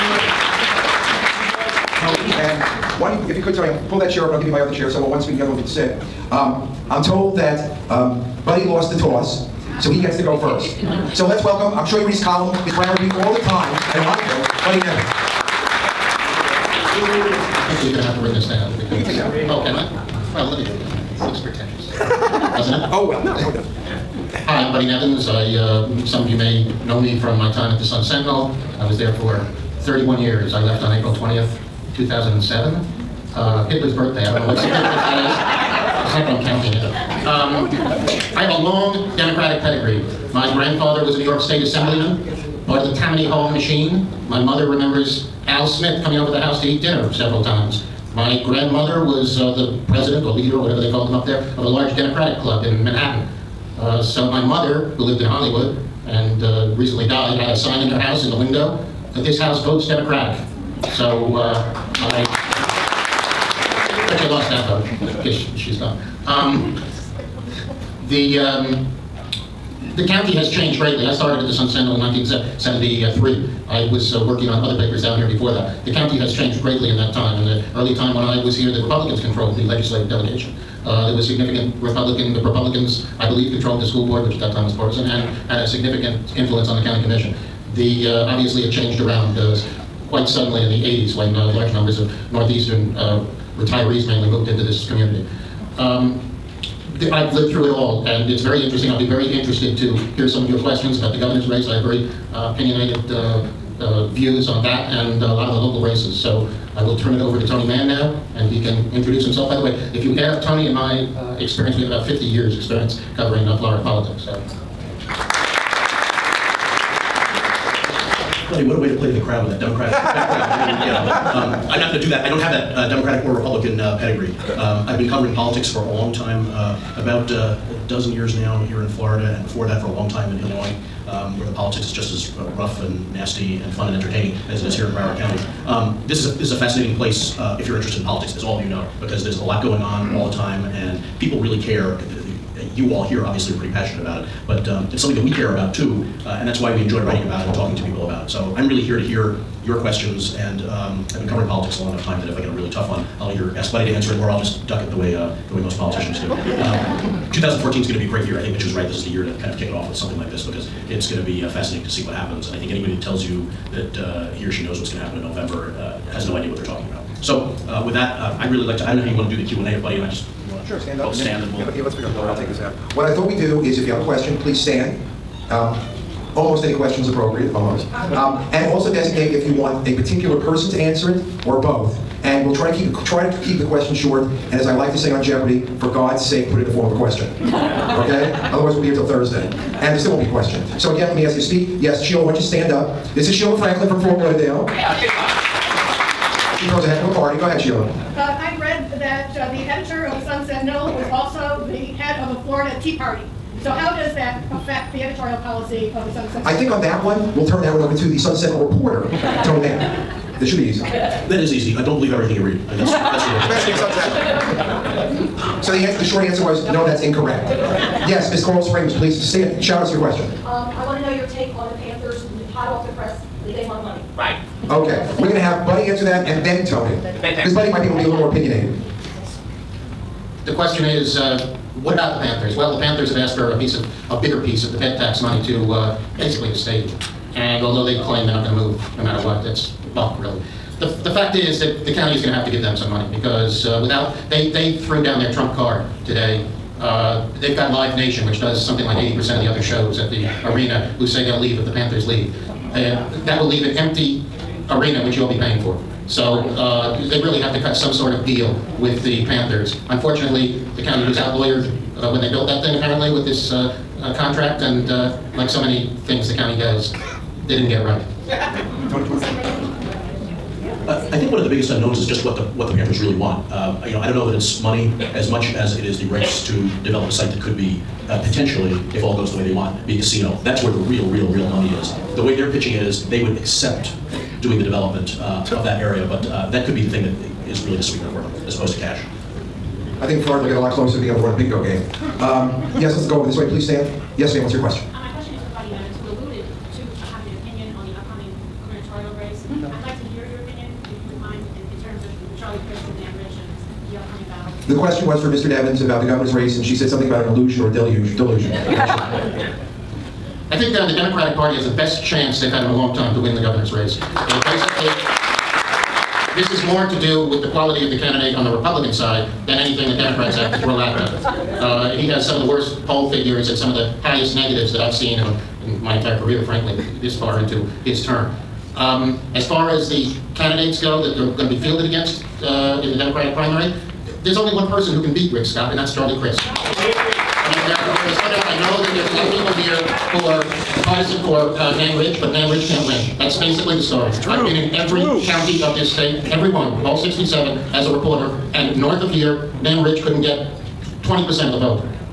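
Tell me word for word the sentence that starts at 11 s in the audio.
So let's welcome, I'm sure you read his column, his Brown read all the time, I don't want to, Buddy never.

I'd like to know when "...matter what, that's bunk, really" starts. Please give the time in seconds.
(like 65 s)
239 s.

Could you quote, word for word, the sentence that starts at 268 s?
Tony, do you want to I think one of the biggest unknowns is just what the what the Panthers really want.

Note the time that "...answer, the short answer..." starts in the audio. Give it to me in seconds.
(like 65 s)
215 s.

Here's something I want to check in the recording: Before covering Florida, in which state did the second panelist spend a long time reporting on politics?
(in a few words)
Illinois.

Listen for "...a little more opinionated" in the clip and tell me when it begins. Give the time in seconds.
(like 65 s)
228 s.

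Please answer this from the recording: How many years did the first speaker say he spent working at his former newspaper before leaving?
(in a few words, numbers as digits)
31.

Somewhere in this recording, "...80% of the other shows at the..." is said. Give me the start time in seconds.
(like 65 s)
248 s.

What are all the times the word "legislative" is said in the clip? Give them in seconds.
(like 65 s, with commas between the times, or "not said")
79 s.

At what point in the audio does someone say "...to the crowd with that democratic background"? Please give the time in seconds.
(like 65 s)
119 s.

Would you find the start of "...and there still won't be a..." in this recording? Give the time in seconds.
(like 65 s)
189 s.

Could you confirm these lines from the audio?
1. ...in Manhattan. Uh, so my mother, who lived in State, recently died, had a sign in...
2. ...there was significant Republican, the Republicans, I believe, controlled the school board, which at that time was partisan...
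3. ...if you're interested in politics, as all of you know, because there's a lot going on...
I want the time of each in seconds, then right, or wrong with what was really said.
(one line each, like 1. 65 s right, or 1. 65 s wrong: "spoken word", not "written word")
1. 52 s wrong: "Hollywood", not "State"
2. 81 s right
3. 137 s right.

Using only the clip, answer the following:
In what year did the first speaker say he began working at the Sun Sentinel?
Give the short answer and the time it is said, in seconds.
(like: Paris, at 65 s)
1973, at 71 s.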